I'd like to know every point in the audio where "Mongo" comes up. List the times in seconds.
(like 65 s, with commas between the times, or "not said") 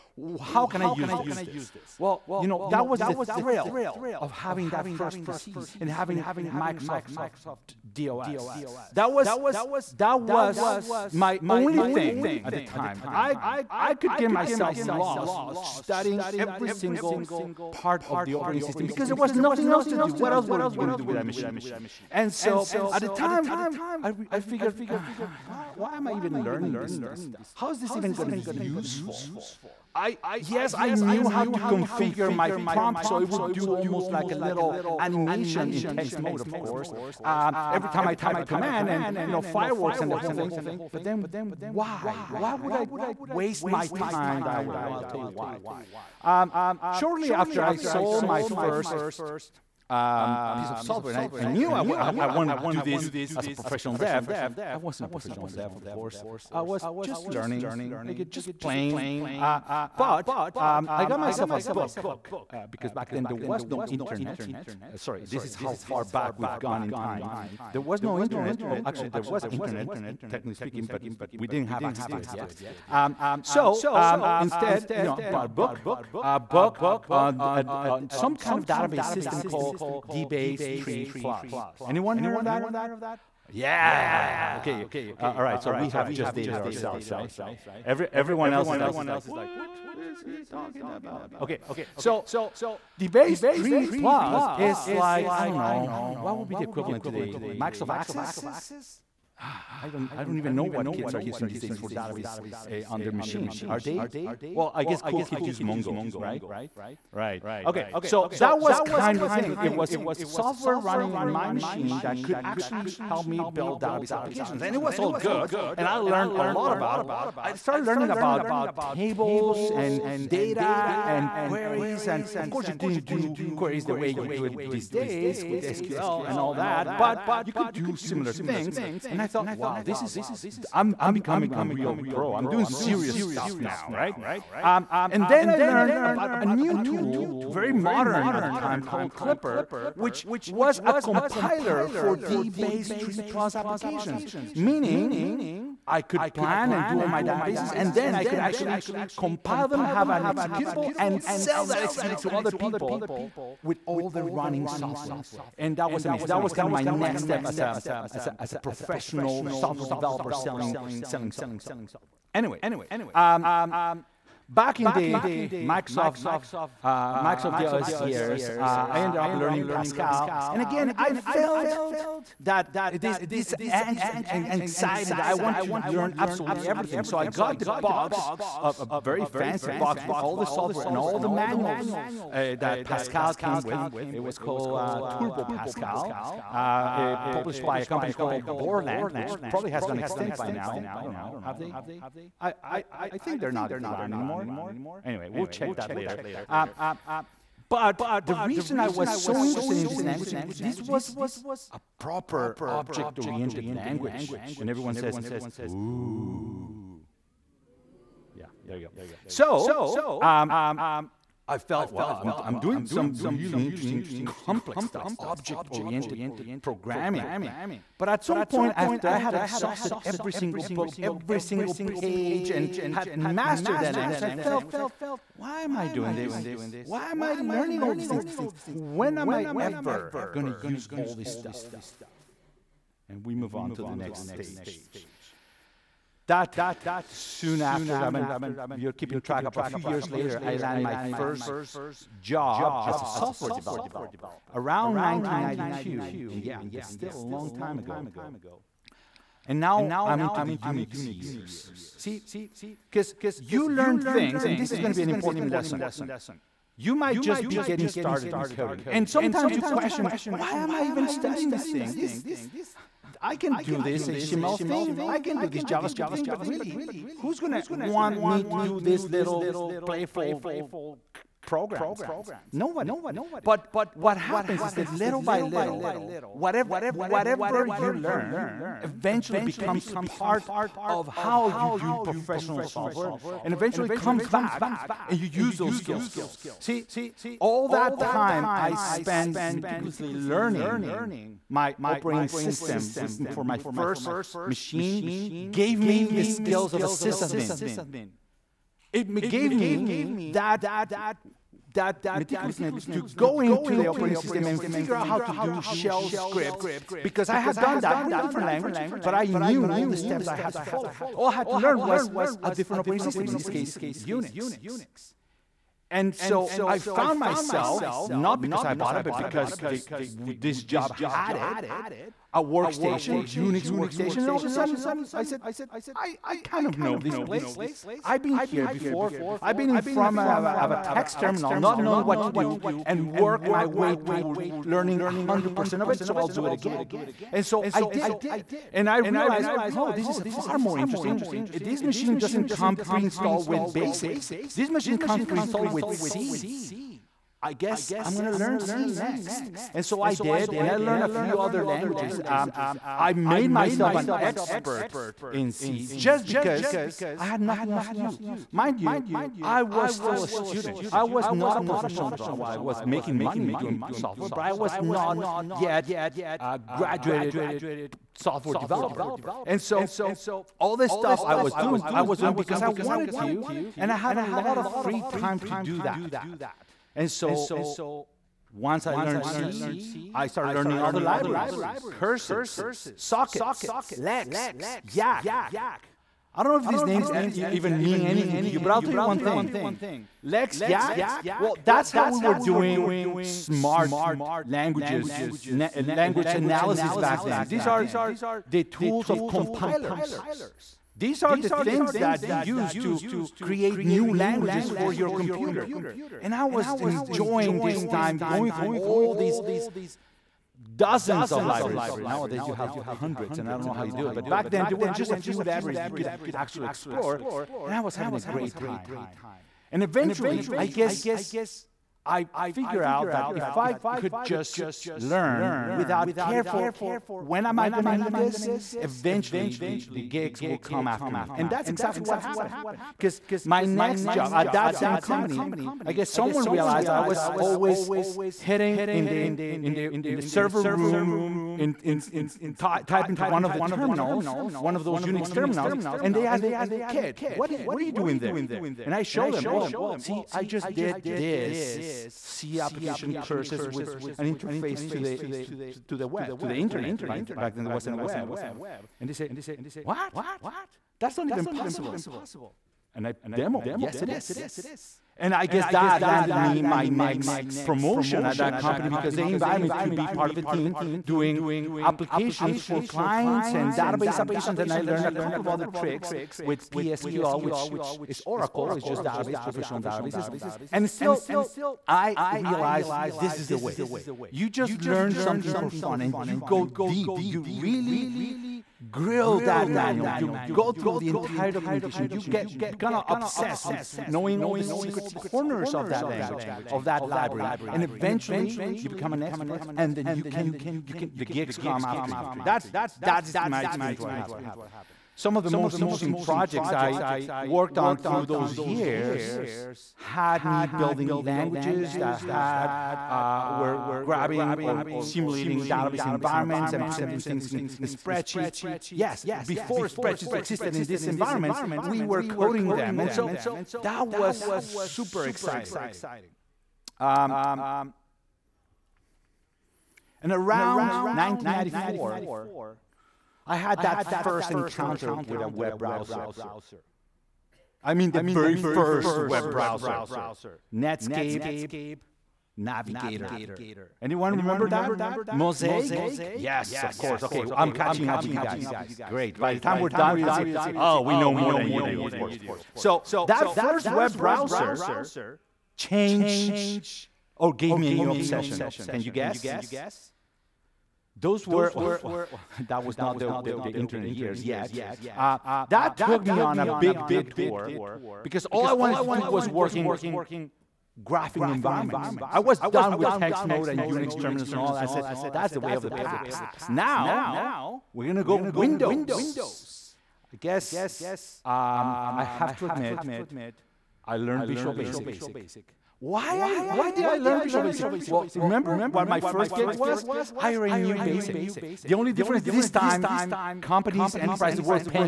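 105 s.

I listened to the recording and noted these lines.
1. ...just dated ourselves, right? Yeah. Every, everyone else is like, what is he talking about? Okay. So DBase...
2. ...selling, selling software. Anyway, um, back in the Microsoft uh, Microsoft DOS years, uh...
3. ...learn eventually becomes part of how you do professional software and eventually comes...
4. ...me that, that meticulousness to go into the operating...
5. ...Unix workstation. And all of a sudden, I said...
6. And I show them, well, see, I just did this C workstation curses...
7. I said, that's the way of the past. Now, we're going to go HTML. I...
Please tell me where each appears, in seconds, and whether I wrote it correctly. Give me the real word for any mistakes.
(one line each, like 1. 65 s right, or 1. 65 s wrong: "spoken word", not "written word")
1. 86 s right
2. 160 s right
3. 277 s right
4. 299 s right
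5. 323 s right
6. 448 s wrong: "application", not "workstation"
7. 574 s wrong: "Windows", not "HTML".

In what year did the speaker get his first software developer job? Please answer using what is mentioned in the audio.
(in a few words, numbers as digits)
1992.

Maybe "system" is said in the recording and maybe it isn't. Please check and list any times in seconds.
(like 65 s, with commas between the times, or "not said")
18 s, 79 s, 292 s, 304 s, 313 s.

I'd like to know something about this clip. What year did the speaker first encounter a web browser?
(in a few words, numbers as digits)
1994.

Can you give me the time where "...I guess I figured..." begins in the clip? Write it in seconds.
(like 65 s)
420 s.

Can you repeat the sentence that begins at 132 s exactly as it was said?
I'm doing serious stuff now, right?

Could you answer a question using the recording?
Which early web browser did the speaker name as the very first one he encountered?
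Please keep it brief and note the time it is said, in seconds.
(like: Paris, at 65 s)
Netscape Navigator, at 540 s.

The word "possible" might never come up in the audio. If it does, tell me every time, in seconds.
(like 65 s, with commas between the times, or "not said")
461 s.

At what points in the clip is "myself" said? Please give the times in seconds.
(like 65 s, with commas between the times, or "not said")
14 s, 61 s, 317 s, 353 s.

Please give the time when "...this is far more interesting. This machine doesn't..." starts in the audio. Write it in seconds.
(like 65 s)
339 s.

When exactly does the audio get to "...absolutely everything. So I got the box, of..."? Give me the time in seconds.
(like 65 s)
176 s.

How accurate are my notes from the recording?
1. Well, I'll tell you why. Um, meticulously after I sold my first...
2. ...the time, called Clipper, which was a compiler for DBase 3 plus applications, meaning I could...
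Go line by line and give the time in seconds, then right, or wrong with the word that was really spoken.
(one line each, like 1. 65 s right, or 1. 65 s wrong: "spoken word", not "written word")
1. 44 s wrong: "shortly", not "meticulously"
2. 138 s right.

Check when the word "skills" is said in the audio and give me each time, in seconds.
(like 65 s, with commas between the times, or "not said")
285 s, 296 s.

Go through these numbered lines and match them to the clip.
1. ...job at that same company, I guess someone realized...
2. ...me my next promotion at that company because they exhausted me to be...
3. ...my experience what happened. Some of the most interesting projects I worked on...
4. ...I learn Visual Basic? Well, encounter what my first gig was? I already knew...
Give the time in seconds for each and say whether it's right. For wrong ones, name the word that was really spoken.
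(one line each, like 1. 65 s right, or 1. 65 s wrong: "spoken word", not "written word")
1. 434 s right
2. 466 s wrong: "invited", not "exhausted"
3. 503 s right
4. 587 s wrong: "remember", not "encounter".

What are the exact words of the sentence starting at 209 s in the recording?
So um, I felt, wow, I'm, I'm doing some really interesting, complex stuff, object oriented programming.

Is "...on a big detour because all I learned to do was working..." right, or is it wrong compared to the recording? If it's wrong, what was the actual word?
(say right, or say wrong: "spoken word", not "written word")
wrong: "wanted", not "learned".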